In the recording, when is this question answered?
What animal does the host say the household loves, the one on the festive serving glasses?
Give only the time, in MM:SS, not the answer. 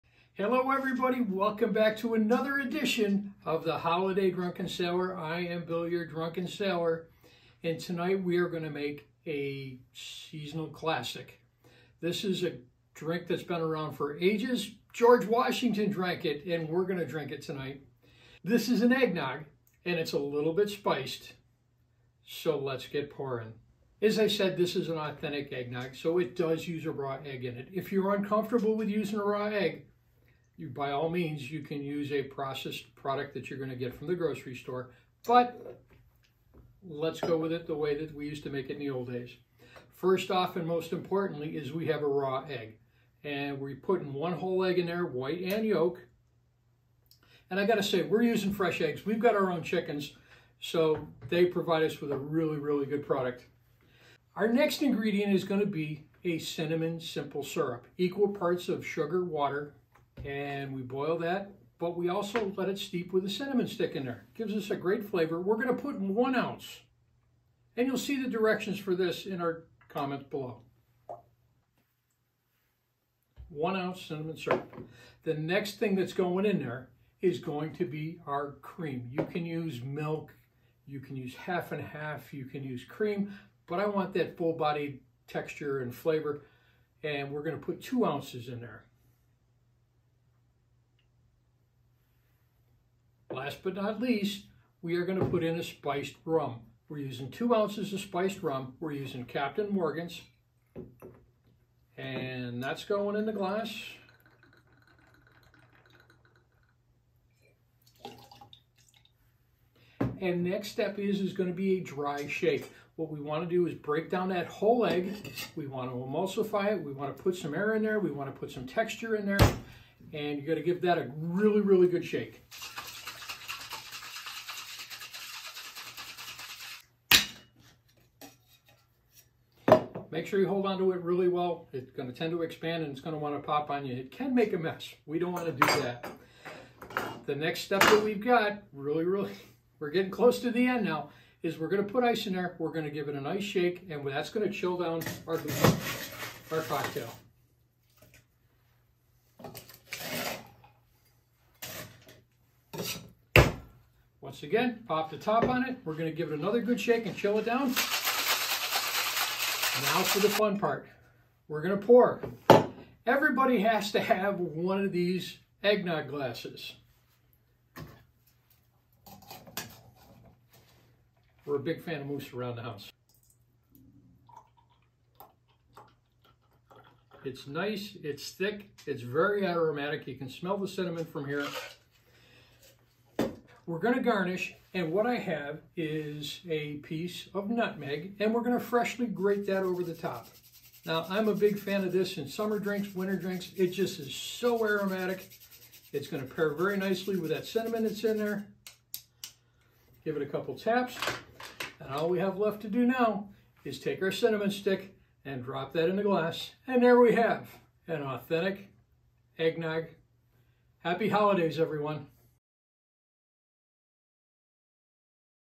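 02:52.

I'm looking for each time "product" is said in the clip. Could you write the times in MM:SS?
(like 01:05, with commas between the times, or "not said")
00:32, 00:53.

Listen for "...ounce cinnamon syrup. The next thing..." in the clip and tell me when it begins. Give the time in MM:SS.
01:13.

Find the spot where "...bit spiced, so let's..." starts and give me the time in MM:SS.
00:20.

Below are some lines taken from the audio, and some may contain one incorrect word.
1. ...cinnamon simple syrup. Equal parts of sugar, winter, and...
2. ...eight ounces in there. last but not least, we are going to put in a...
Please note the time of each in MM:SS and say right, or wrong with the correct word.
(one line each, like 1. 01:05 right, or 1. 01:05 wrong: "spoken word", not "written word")
1. 00:56 wrong: "water", not "winter"
2. 01:27 wrong: "two", not "eight".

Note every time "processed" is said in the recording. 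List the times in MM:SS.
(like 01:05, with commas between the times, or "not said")
00:32.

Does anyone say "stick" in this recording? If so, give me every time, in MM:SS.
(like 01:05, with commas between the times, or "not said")
01:03, 03:24.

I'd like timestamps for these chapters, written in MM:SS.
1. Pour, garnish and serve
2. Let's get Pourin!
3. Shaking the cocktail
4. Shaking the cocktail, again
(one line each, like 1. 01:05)
1. 02:42
2. 00:25
3. 01:52
4. 02:30.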